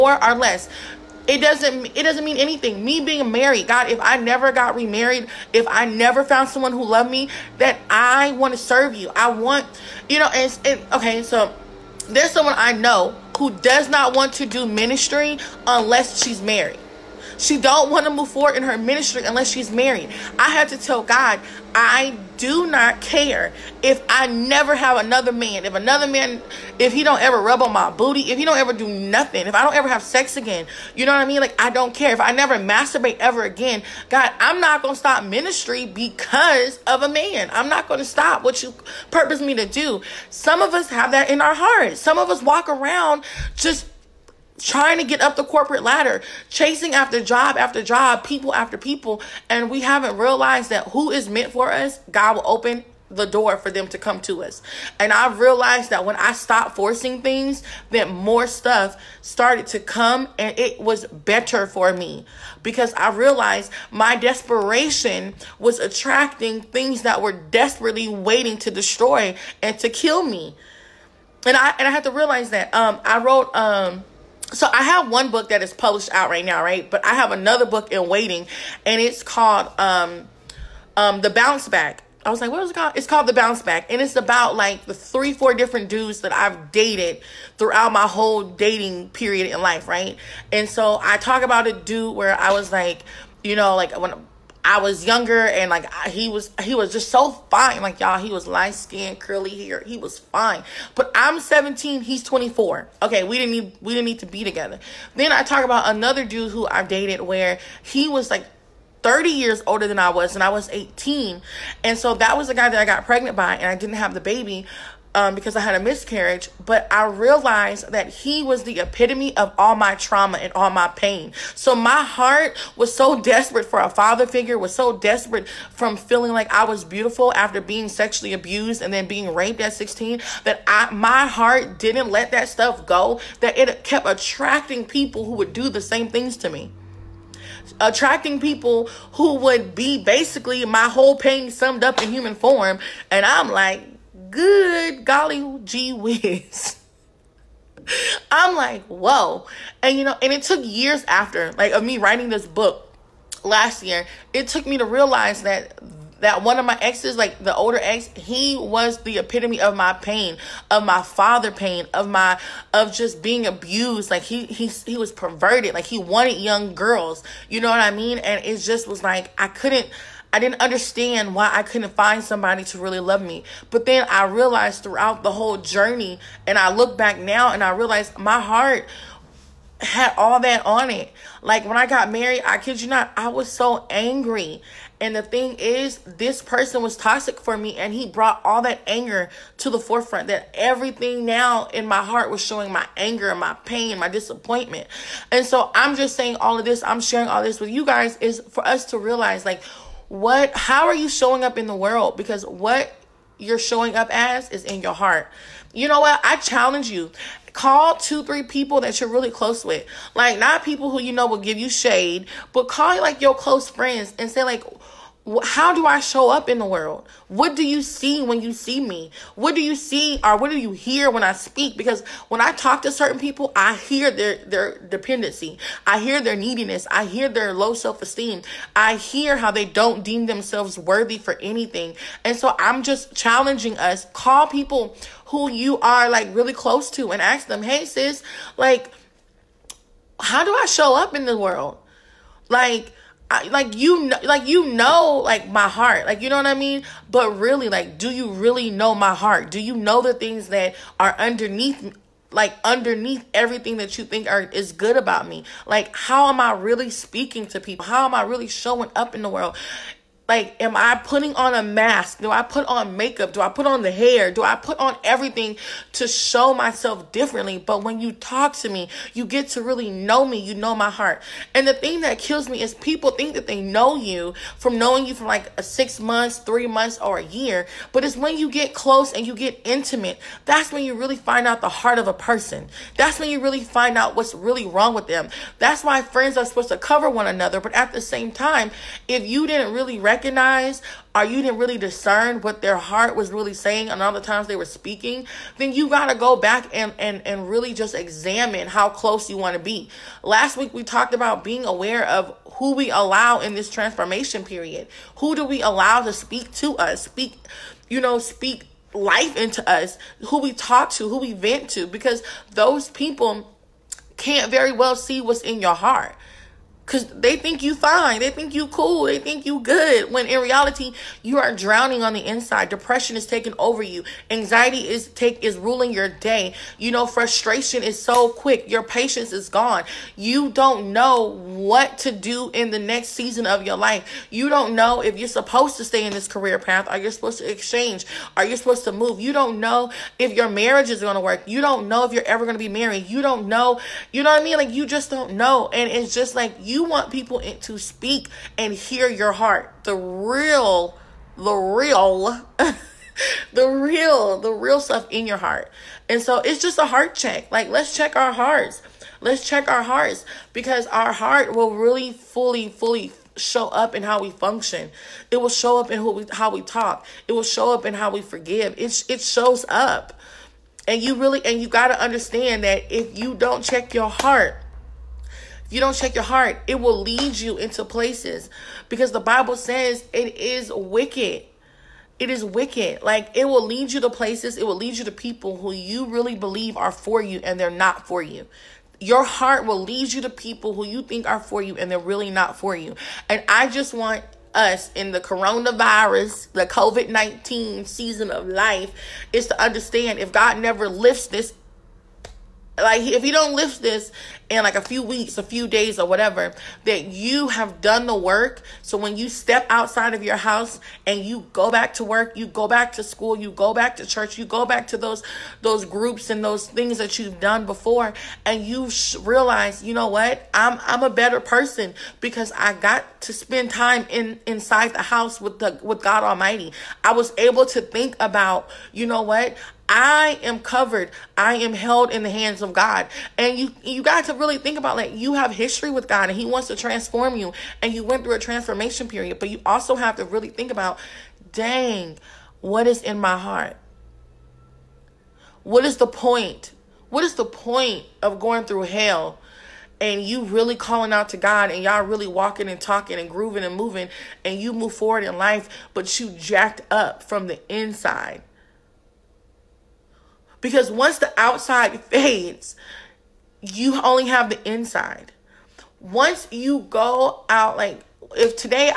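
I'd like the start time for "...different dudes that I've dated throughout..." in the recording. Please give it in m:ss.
1:25.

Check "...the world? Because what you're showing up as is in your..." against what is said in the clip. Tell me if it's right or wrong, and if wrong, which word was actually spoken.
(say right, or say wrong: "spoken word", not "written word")
right.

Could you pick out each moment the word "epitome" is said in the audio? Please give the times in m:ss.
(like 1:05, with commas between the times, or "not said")
1:58, 2:39.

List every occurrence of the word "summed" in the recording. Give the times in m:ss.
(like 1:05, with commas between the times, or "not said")
2:21.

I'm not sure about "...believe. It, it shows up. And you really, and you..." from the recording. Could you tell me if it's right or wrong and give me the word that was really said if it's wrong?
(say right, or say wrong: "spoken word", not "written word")
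wrong: "forgive", not "believe".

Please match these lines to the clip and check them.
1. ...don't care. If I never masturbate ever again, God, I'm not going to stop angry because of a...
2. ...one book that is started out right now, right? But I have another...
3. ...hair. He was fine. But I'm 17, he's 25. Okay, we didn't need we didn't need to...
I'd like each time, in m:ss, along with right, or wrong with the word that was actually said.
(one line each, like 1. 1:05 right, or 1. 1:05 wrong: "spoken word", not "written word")
1. 0:31 wrong: "ministry", not "angry"
2. 1:15 wrong: "published", not "started"
3. 1:39 wrong: "24", not "25".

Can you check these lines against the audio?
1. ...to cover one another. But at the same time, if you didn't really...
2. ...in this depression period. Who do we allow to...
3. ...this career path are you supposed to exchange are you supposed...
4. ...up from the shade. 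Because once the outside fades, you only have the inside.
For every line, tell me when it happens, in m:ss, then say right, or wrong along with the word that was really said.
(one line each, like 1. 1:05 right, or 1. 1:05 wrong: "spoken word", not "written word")
1. 4:46 right
2. 5:03 wrong: "transformation", not "depression"
3. 5:36 right
4. 7:36 wrong: "inside", not "shade".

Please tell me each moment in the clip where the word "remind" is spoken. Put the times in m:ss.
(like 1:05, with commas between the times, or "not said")
not said.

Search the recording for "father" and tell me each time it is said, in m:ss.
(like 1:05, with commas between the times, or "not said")
2:03, 2:40.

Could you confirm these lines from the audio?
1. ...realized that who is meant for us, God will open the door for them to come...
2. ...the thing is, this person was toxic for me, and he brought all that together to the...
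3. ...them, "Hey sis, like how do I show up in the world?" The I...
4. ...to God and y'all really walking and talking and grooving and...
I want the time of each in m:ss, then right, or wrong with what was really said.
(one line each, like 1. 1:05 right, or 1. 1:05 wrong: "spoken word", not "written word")
1. 0:50 right
2. 3:05 wrong: "anger", not "together"
3. 3:57 wrong: "Like", not "The"
4. 7:31 right.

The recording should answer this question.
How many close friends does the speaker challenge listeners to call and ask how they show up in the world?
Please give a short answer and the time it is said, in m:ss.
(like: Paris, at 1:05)
2 or 3, at 3:27.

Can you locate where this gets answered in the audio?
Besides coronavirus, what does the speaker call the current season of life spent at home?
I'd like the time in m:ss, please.
6:36.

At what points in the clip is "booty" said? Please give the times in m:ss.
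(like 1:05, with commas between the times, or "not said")
0:27.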